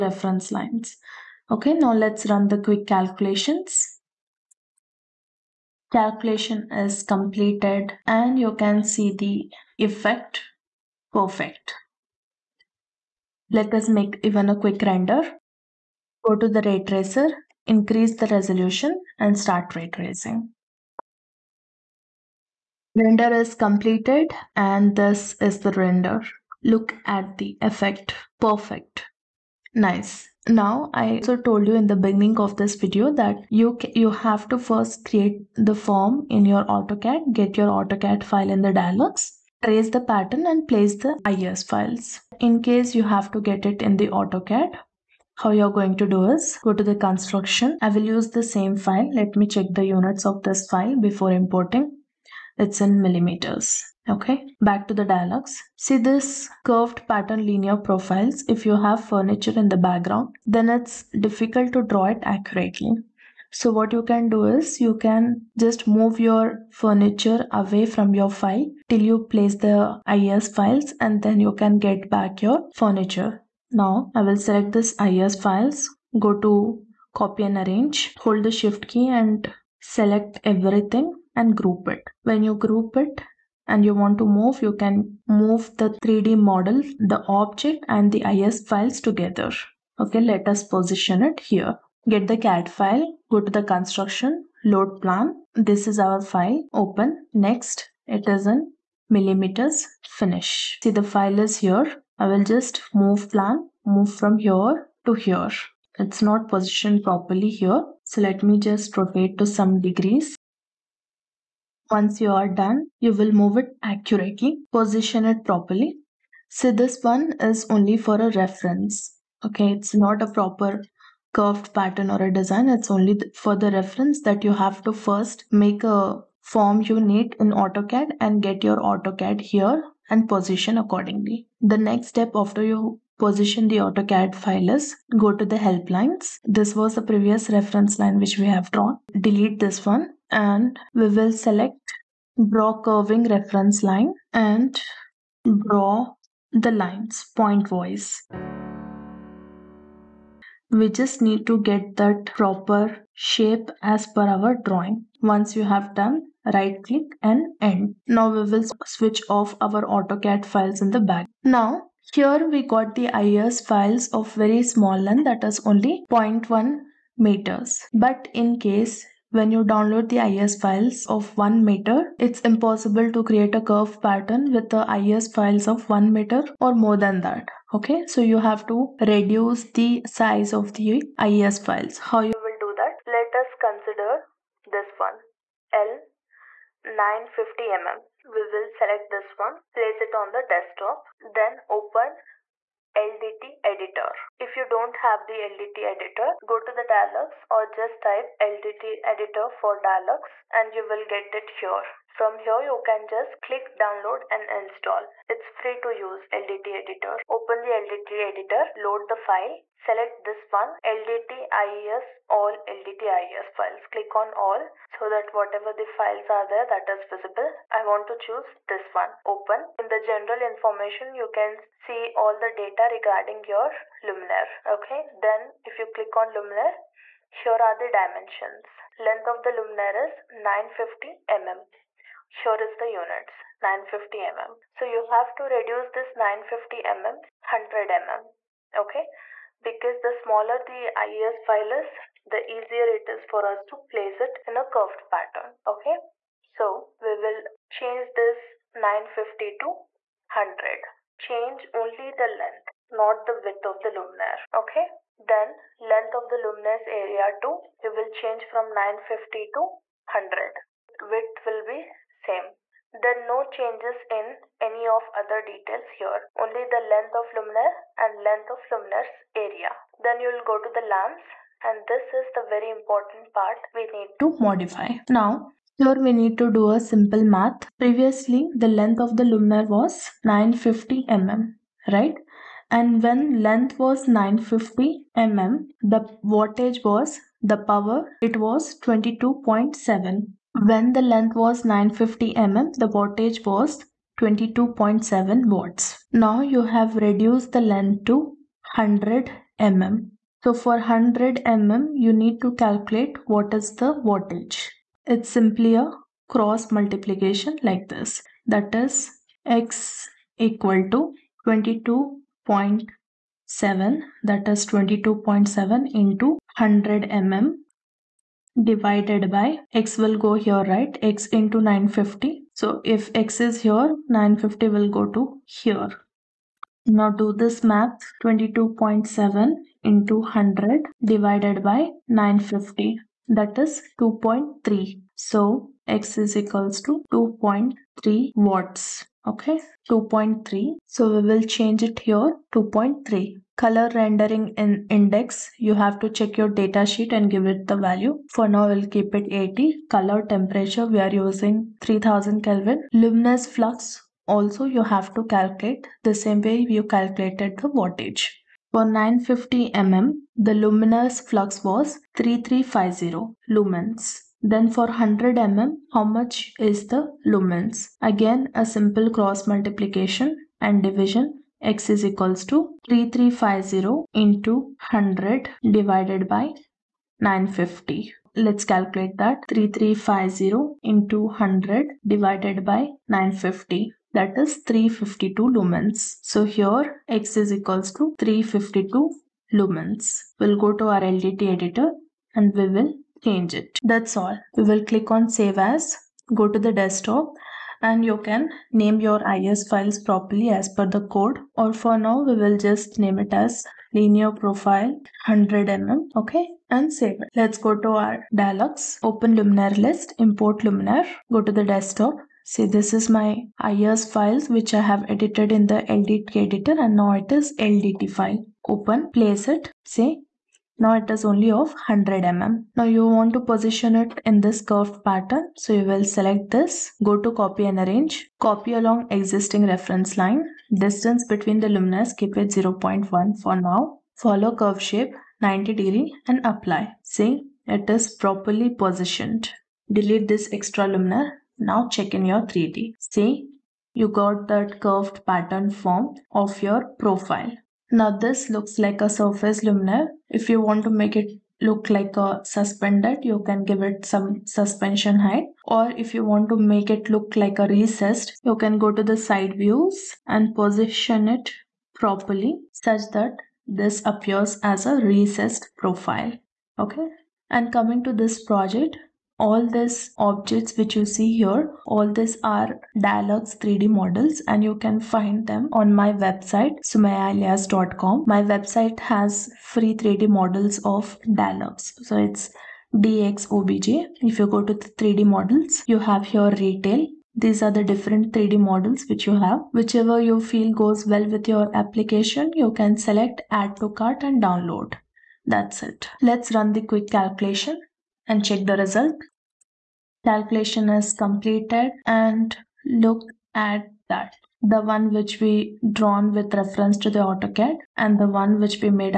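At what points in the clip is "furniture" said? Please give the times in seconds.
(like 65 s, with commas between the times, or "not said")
59 s, 66 s, 72 s.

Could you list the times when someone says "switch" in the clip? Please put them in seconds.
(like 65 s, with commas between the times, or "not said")
158 s.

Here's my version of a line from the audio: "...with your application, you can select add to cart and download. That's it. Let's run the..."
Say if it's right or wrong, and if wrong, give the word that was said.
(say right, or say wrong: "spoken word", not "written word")
right.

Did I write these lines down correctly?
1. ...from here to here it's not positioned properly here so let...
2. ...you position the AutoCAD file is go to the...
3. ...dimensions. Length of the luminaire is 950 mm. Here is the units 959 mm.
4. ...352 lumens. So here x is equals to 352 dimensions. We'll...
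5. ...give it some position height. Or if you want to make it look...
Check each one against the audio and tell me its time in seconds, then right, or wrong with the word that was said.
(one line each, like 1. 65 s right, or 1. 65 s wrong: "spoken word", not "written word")
1. 104 s right
2. 132 s right
3. 227 s wrong: "950", not "959"
4. 384 s wrong: "lumens", not "dimensions"
5. 453 s wrong: "suspension", not "position".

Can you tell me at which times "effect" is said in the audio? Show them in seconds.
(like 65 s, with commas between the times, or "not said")
9 s, 27 s.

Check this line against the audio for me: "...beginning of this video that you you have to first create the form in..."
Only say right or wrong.
right.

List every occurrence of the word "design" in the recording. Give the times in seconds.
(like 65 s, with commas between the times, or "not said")
122 s.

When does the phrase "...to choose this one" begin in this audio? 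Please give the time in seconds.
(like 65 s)
218 s.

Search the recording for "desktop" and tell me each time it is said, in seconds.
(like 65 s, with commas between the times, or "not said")
190 s, 396 s, 411 s.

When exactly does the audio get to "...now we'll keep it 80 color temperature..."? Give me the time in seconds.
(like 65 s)
348 s.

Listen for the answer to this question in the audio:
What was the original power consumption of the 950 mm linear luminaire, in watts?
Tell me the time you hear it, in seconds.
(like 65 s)
294 s.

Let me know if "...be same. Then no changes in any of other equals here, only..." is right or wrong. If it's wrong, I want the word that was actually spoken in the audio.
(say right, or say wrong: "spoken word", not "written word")
wrong: "details", not "equals".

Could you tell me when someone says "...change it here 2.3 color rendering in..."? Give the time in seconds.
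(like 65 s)
341 s.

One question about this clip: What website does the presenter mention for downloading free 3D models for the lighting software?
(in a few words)
sumayalias.com.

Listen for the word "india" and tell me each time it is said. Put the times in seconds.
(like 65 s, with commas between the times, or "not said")
not said.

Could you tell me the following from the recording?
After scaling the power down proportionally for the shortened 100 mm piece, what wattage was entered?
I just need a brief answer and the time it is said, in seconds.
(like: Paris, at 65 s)
2.3 watts, at 337 s.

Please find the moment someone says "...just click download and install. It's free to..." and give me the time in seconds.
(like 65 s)
203 s.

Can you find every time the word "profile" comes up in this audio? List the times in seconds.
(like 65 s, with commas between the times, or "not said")
57 s, 404 s, 446 s, 465 s.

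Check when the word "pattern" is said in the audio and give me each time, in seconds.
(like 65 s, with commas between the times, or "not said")
40 s, 57 s, 121 s, 173 s, 245 s, 425 s, 445 s.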